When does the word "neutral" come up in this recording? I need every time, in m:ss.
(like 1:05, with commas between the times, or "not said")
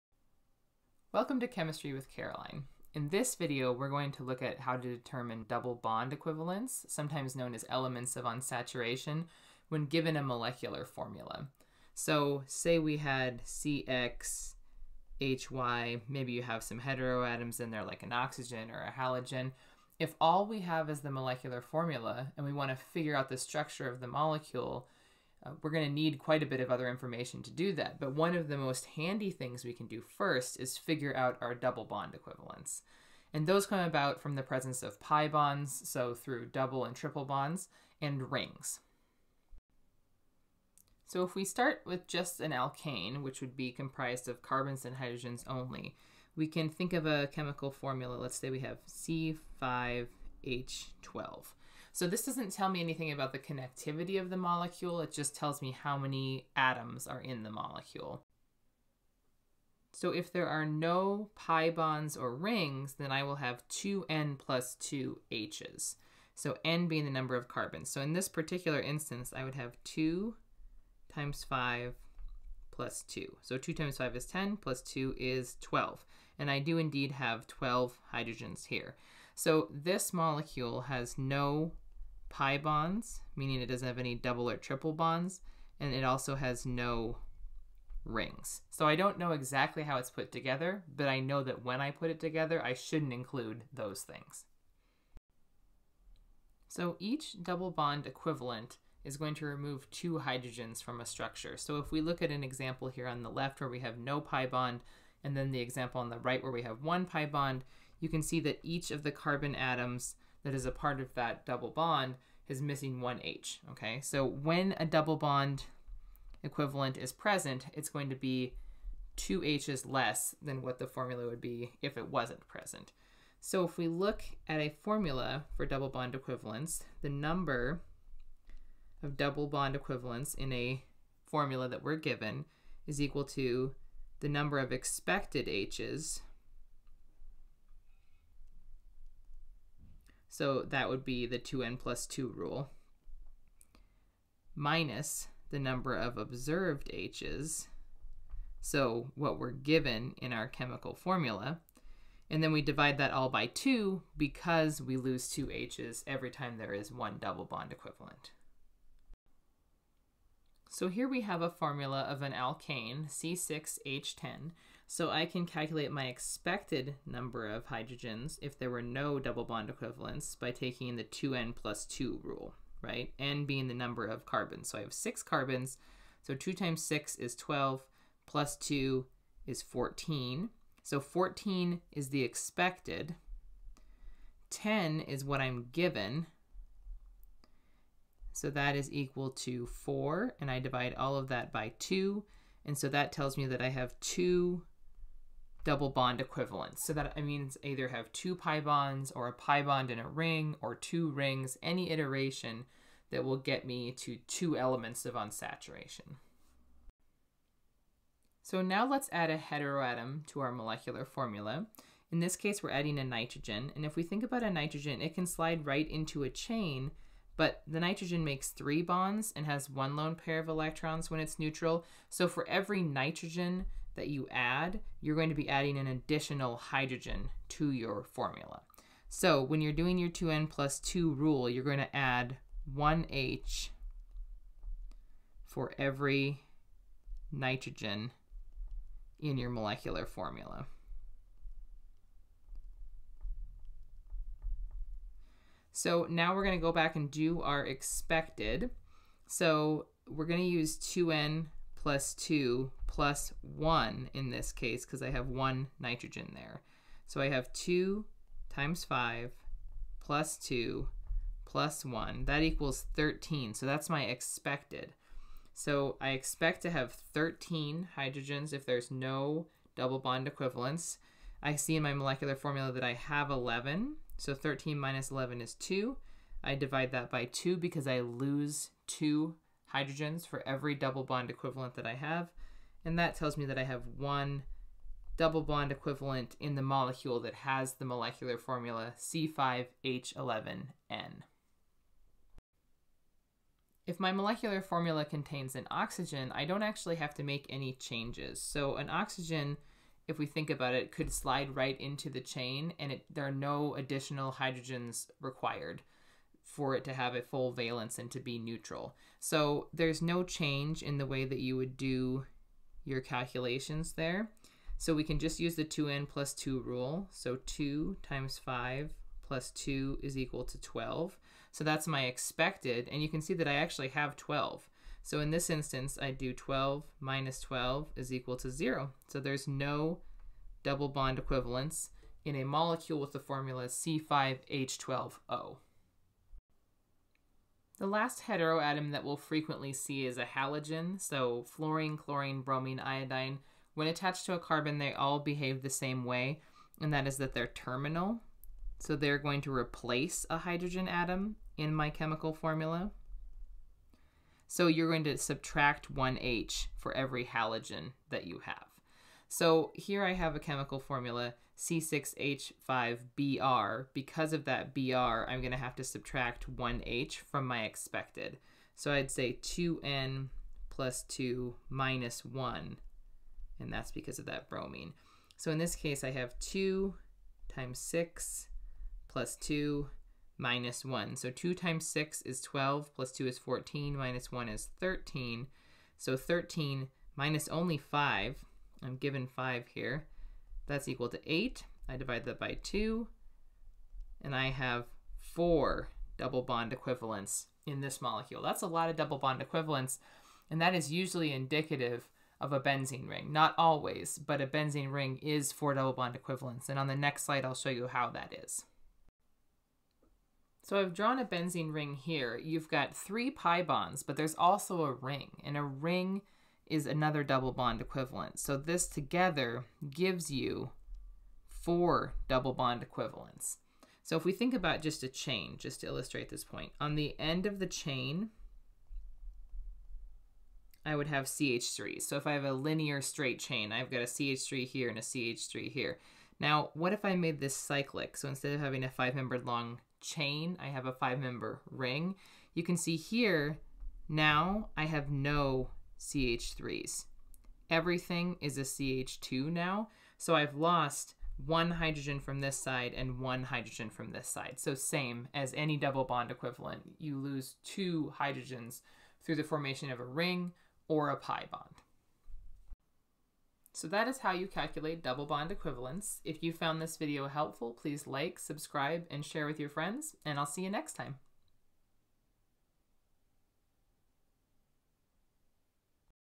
3:41, 5:08.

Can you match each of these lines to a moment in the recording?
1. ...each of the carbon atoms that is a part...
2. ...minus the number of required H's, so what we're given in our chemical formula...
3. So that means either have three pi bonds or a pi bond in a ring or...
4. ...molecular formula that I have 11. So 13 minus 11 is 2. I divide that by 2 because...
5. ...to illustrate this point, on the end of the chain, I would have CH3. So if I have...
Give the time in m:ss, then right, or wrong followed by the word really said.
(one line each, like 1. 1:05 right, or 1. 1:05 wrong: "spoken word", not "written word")
1. 1:48 right
2. 2:24 wrong: "observed", not "required"
3. 3:16 wrong: "two", not "three"
4. 4:31 right
5. 7:05 right.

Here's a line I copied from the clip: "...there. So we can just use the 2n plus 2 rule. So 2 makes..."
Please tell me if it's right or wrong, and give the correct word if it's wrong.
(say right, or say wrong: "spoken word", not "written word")
wrong: "times", not "makes".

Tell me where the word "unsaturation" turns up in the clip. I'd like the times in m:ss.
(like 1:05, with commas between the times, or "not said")
0:08, 3:25.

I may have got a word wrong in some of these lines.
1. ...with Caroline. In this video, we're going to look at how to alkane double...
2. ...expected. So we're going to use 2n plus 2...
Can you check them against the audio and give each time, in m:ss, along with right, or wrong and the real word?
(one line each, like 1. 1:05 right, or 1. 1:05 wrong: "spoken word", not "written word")
1. 0:01 wrong: "determine", not "alkane"
2. 4:07 right.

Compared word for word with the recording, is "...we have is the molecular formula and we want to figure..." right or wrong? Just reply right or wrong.
right.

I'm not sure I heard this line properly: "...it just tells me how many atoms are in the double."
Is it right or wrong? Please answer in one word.
wrong.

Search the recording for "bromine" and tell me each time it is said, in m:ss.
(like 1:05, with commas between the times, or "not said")
5:42, 6:14.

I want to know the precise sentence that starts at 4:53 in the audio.
If my molecular formula contains an oxygen, I don't actually have to make any changes.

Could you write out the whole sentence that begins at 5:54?
So you're going to subtract 1H for every halogen that you have.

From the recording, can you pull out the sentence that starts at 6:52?
You've got three pi bonds, but there's also a ring, and a ring is another double bond equivalent.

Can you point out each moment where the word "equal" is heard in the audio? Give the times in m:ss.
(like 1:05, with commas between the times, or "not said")
2:12, 3:08, 4:22, 5:20, 5:28, 6:30.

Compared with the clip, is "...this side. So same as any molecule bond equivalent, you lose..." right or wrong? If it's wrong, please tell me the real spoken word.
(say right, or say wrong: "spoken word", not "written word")
wrong: "double", not "molecule".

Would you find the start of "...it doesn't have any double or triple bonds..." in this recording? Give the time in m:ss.
1:23.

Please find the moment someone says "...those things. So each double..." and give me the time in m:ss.
1:33.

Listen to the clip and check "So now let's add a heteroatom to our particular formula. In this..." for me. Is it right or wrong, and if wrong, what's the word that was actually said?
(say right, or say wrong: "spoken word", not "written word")
wrong: "molecular", not "particular".